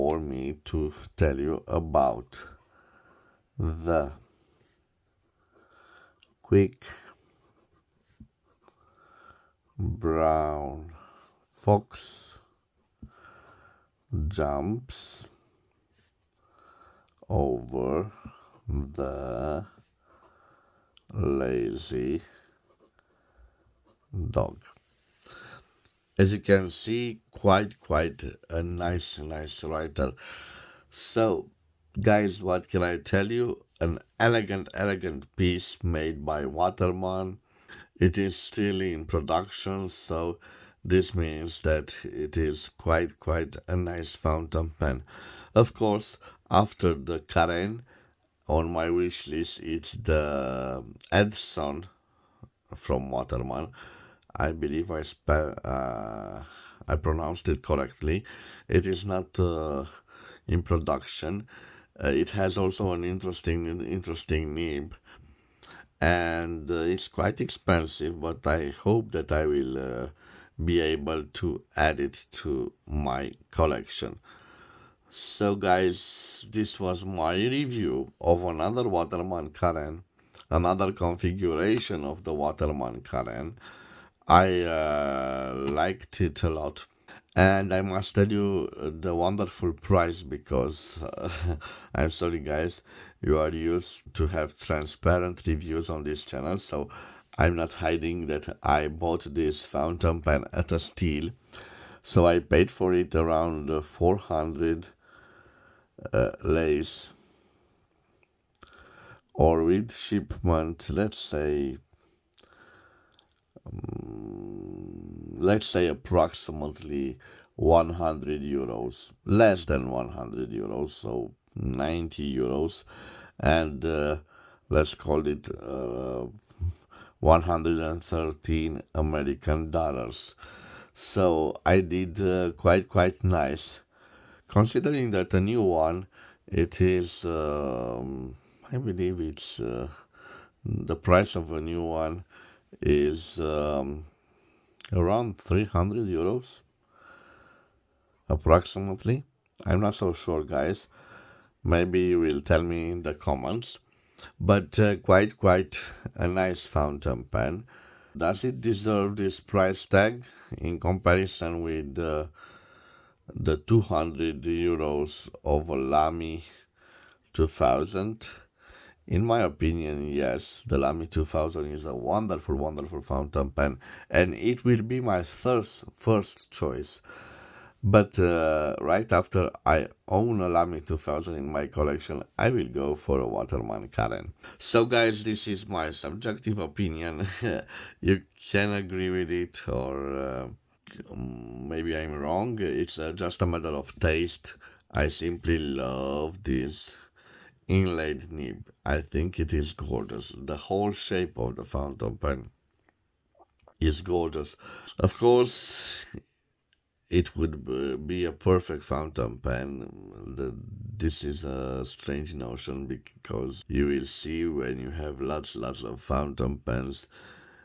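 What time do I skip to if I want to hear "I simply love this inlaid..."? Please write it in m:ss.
3:14.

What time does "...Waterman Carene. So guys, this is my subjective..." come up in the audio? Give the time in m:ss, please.
3:03.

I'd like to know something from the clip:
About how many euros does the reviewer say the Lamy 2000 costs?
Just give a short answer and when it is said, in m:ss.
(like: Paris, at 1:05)
200 euros, at 2:43.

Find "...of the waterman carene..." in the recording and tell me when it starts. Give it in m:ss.
1:22.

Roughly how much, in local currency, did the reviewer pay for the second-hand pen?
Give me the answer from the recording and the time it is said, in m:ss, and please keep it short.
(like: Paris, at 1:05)
400 lei, at 1:43.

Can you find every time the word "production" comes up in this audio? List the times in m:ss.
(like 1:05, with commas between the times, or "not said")
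0:39, 1:00.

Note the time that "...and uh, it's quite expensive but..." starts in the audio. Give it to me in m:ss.
1:06.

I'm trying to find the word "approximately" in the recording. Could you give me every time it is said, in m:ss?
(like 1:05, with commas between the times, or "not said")
1:55, 2:28.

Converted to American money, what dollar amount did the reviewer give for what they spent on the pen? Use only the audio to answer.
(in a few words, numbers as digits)
113 dollars.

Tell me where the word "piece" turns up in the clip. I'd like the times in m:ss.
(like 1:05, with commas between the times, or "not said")
0:35.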